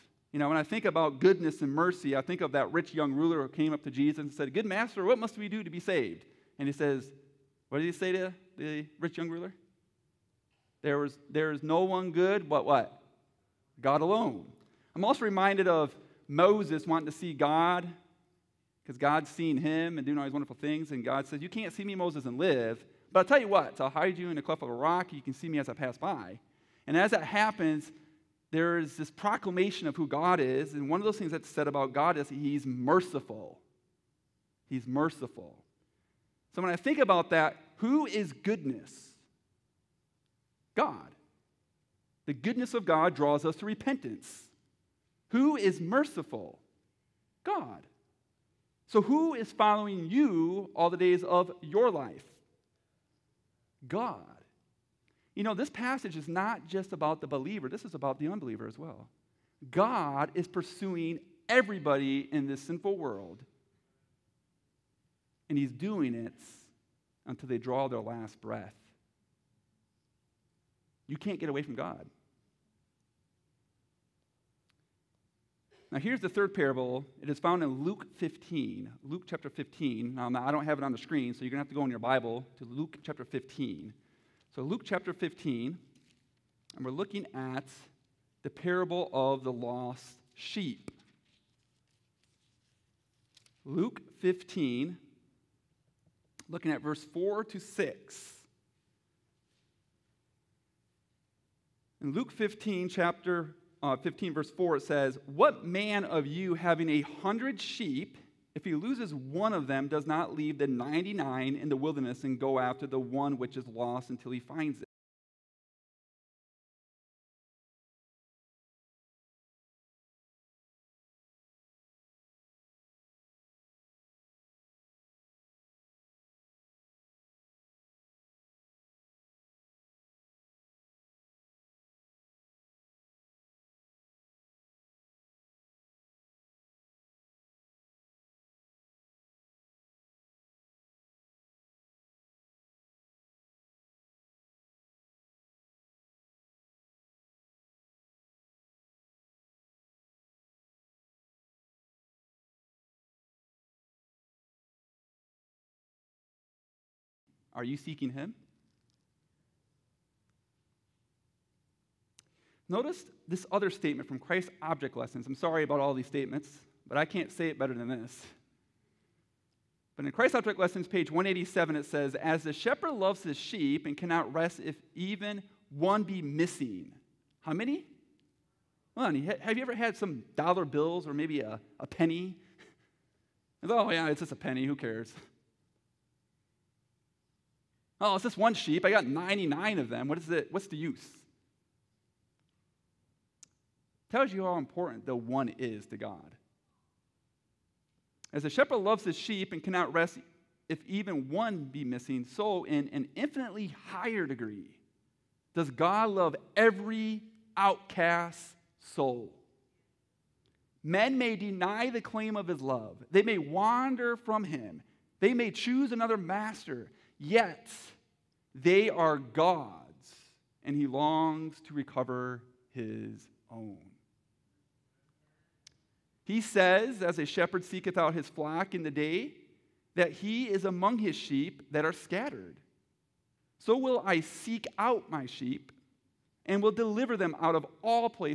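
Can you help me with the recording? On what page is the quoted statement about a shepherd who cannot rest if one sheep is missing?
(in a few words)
187.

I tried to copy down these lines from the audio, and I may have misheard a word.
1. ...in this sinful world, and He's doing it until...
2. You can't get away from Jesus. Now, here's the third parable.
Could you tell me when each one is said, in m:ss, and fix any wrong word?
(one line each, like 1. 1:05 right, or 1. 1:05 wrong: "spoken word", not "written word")
1. 1:02 right
2. 1:11 wrong: "God", not "Jesus".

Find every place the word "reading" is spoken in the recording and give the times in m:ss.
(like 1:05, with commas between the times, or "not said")
not said.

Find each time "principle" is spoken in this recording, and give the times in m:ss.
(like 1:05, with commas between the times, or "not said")
not said.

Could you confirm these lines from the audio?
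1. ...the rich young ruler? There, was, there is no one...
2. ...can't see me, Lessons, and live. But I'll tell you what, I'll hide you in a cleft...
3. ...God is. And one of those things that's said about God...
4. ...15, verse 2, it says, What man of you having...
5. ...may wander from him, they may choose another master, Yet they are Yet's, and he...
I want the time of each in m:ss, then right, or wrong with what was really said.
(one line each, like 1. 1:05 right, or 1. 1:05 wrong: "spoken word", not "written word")
1. 0:08 right
2. 0:21 wrong: "Moses", not "Lessons"
3. 0:30 right
4. 1:43 wrong: "4", not "2"
5. 3:33 wrong: "God", not "Yet".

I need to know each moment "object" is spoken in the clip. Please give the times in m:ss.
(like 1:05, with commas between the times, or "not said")
2:44, 2:50.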